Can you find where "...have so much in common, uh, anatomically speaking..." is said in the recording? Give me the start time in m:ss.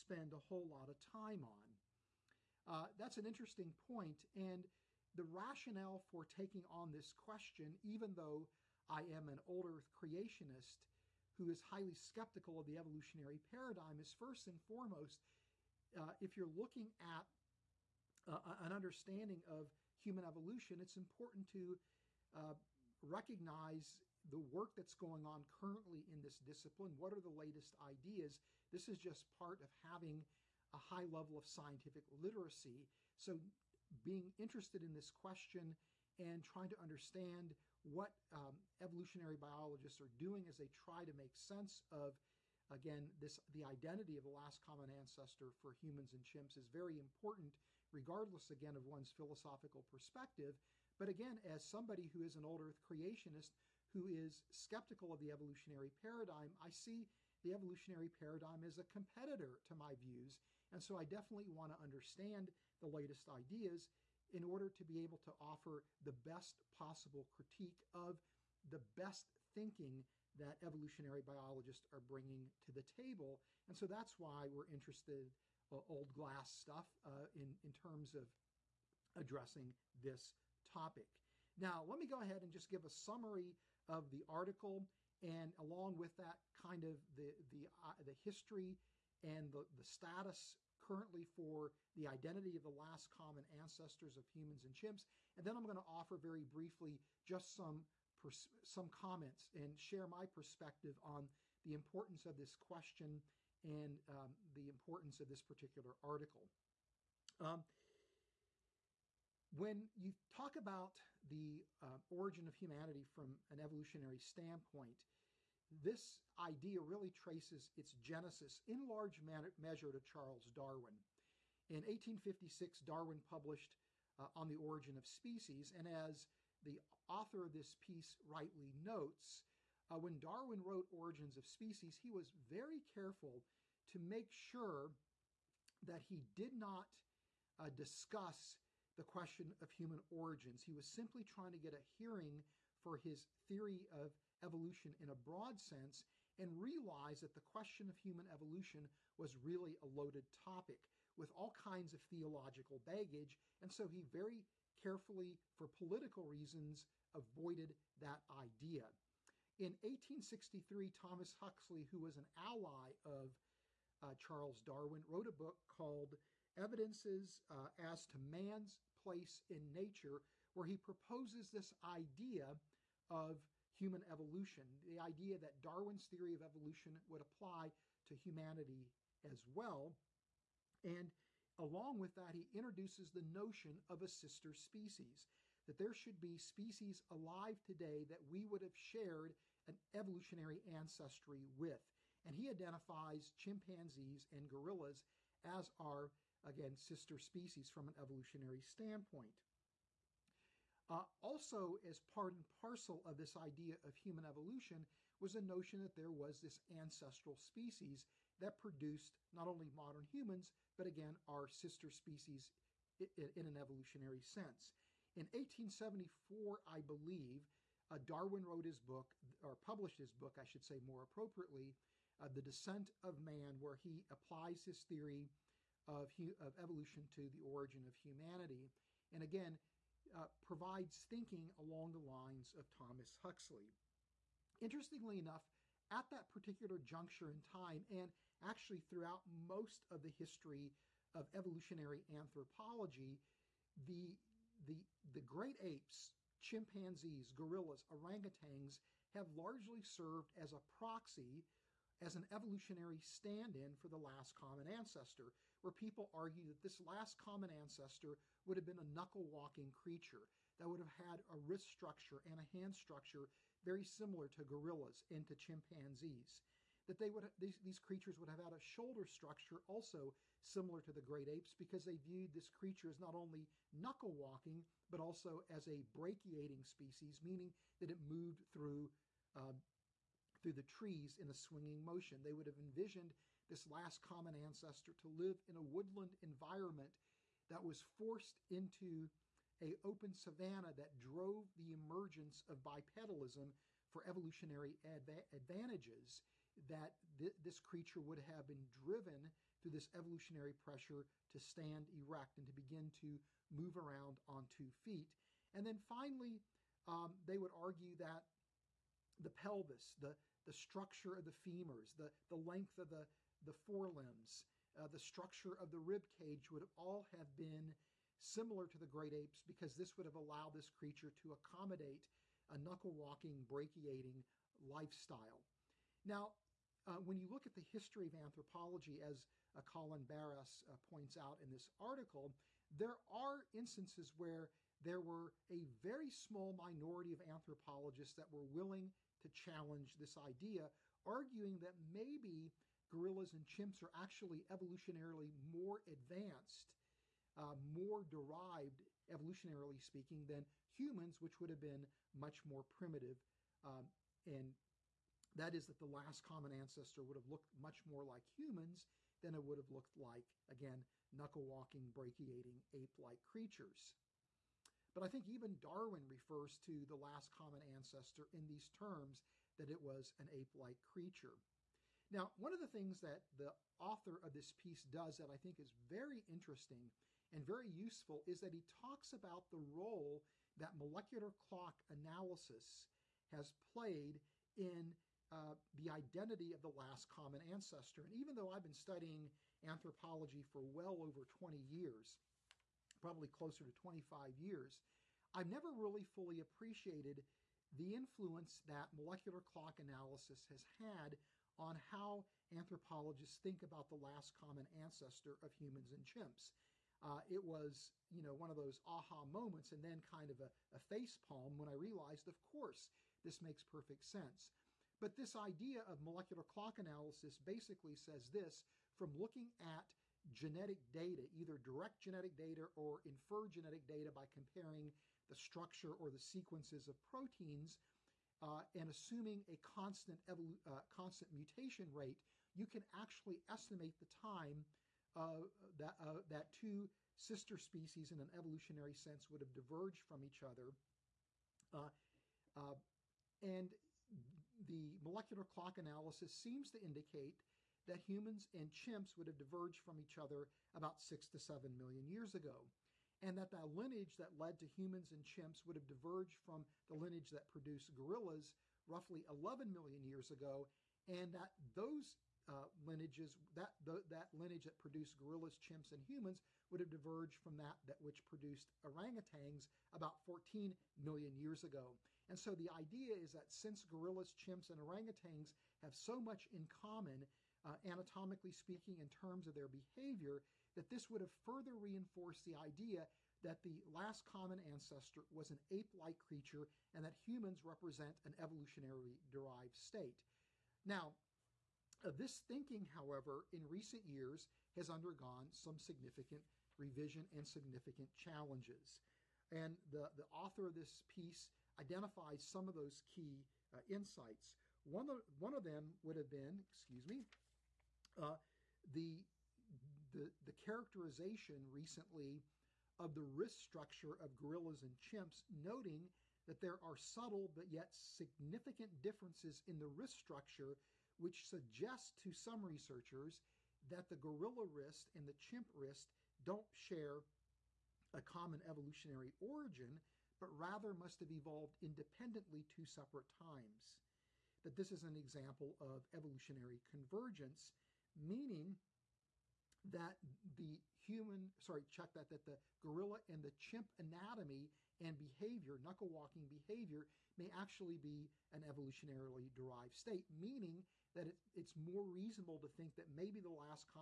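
7:55.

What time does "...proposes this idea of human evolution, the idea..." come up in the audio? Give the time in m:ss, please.
2:50.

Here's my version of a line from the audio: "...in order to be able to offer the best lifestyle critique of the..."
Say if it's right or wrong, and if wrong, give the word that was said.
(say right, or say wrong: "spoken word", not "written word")
wrong: "possible", not "lifestyle".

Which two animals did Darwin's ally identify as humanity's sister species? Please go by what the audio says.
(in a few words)
chimpanzees and gorillas.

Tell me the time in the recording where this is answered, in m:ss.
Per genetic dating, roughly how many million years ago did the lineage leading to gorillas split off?
7:39.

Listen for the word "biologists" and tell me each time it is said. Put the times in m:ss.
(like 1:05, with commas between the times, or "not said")
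0:39, 1:11.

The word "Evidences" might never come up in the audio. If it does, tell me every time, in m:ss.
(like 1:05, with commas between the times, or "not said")
2:46.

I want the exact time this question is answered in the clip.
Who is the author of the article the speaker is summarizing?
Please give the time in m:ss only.
5:29.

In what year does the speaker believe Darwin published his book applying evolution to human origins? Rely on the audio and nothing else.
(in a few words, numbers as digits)
1874.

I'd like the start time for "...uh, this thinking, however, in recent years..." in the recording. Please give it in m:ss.
8:12.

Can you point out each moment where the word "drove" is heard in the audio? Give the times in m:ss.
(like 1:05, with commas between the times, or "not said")
4:50.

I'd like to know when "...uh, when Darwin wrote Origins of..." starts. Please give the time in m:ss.
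2:09.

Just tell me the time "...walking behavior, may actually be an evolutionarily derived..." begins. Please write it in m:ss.
9:06.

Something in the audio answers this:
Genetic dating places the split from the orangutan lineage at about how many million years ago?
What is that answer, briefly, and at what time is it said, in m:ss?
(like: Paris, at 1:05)
14, at 7:50.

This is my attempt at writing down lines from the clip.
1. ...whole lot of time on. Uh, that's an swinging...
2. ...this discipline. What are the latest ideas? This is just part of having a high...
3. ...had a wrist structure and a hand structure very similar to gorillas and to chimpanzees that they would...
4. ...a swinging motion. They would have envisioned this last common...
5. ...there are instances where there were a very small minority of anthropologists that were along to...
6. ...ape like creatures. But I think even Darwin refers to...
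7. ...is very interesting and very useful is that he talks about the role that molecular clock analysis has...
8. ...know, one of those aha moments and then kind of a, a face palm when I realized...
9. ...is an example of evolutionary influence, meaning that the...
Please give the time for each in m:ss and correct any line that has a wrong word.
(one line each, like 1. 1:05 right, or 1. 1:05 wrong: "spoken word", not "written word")
1. 0:00 wrong: "interesting", not "swinging"
2. 0:26 right
3. 4:20 right
4. 4:41 right
5. 5:32 wrong: "willing", not "along"
6. 6:02 right
7. 6:15 right
8. 6:48 right
9. 8:54 wrong: "convergence", not "influence".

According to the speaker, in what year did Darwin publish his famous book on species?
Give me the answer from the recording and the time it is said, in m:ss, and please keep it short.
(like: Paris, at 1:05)
1856, at 2:01.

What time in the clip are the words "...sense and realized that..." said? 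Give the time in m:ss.
2:25.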